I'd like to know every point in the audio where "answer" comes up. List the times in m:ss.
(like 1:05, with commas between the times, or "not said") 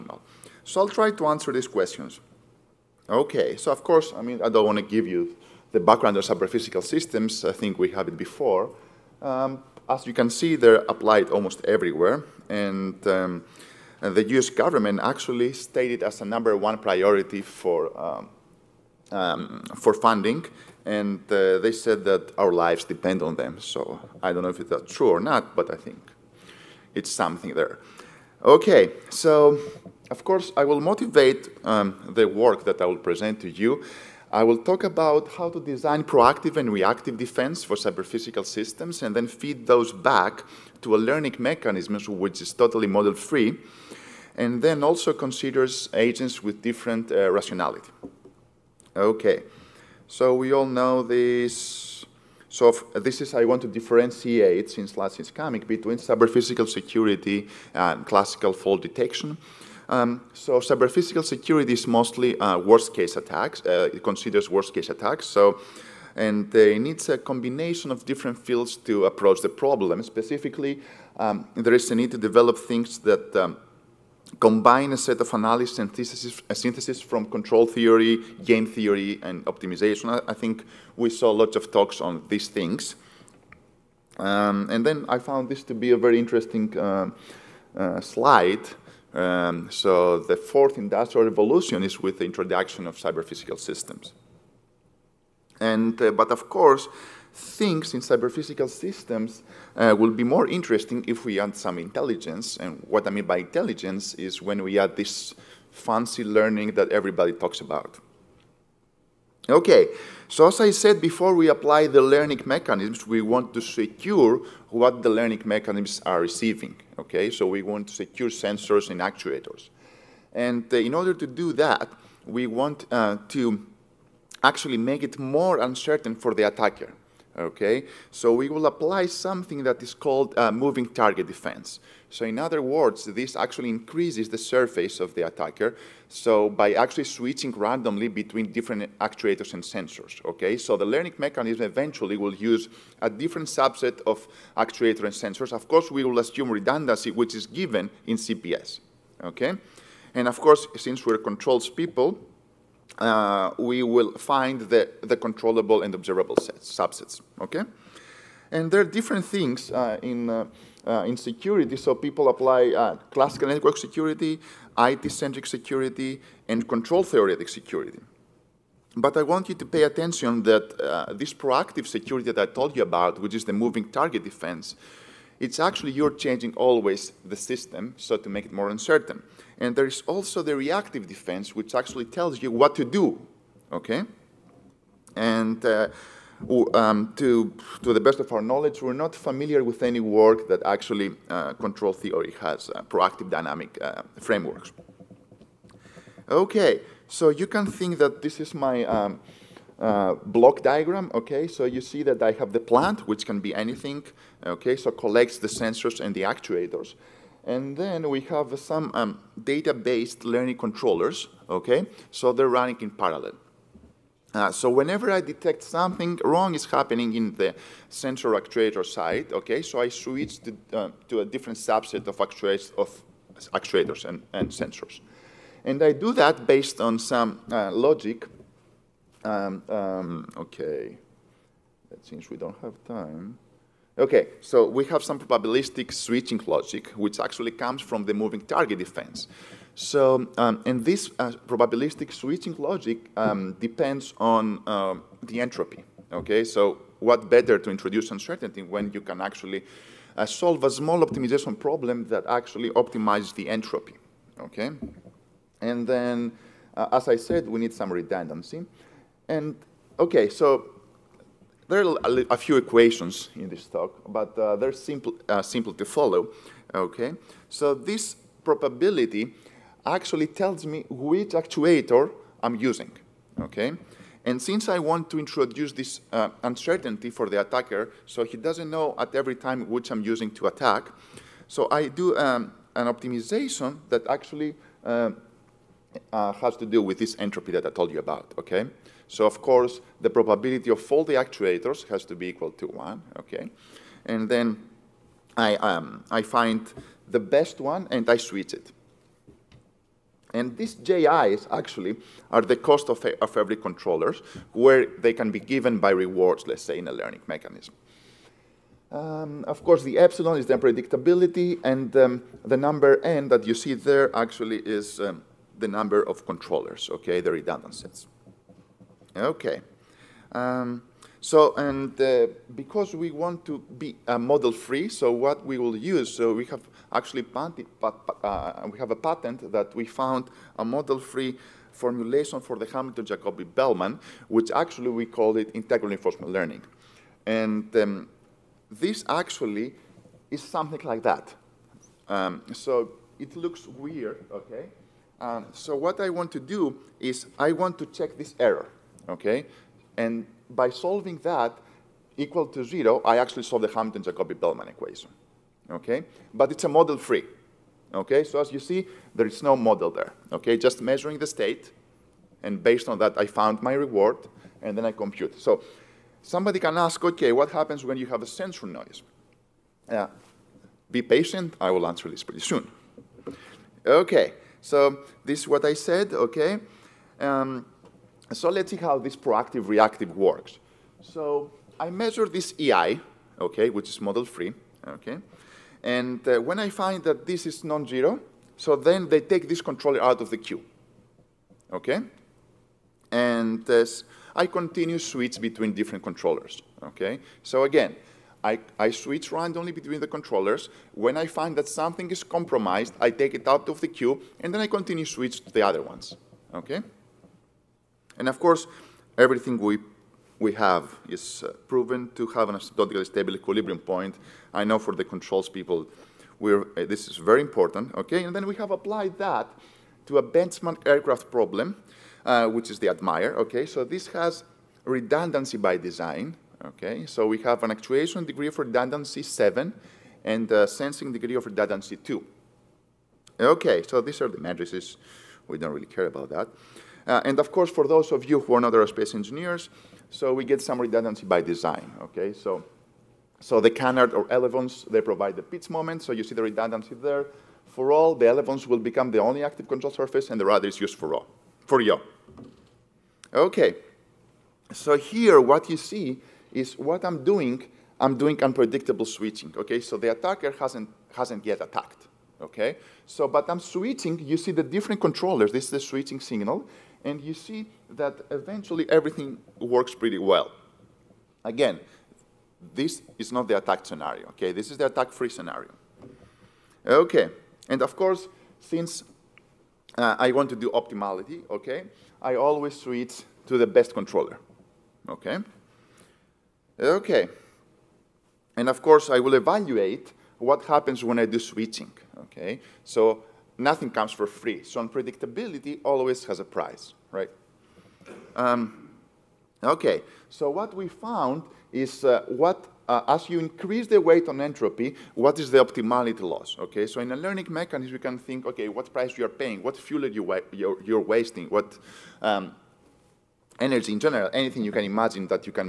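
0:01, 6:11.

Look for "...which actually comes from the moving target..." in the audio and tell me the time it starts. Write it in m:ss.
3:56.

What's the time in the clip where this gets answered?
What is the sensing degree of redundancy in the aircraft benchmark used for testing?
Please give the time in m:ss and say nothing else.
7:11.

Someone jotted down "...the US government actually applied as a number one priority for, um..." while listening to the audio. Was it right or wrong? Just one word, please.
wrong.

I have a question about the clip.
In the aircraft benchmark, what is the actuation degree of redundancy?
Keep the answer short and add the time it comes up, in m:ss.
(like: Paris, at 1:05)
7, at 7:09.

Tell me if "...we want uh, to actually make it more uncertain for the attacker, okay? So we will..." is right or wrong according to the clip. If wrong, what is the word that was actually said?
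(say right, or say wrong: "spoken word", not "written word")
right.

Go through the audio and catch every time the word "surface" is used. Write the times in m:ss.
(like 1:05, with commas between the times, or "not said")
2:14, 7:29.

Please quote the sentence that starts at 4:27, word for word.
So this probability actually tells me which actuator I'm using, okay?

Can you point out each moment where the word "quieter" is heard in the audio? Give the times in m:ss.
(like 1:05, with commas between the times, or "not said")
not said.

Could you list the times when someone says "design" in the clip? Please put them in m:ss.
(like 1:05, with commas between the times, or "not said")
0:35, 7:05, 7:21.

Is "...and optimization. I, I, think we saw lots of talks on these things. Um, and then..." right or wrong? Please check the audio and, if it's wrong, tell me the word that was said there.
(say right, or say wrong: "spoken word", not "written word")
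right.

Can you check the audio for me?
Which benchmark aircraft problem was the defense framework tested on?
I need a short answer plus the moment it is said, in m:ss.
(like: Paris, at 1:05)
ADMIRE, at 7:02.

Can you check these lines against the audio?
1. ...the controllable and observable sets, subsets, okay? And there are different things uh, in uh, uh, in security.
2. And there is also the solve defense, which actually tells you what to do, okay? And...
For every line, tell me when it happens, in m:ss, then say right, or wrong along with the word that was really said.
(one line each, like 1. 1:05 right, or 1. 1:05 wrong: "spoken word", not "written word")
1. 2:35 right
2. 2:59 wrong: "reactive", not "solve".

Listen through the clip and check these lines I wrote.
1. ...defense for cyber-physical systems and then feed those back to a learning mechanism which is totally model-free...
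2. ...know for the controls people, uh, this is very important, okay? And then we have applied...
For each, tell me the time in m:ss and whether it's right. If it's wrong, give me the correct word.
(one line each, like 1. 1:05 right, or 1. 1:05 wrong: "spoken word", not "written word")
1. 0:37 right
2. 6:54 right.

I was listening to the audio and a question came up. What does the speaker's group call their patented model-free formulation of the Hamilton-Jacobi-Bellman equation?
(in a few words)
integral reinforcement learning.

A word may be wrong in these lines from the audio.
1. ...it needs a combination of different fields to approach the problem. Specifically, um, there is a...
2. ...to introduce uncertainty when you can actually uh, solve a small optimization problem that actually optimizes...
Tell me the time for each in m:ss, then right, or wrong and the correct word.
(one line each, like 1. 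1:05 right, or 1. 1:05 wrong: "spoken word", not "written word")
1. 1:06 right
2. 4:07 right.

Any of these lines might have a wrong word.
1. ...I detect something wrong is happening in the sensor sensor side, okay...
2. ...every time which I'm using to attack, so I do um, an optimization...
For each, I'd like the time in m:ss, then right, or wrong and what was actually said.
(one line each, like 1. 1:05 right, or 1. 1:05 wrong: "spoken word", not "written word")
1. 3:35 wrong: "actuator", not "sensor"
2. 4:39 right.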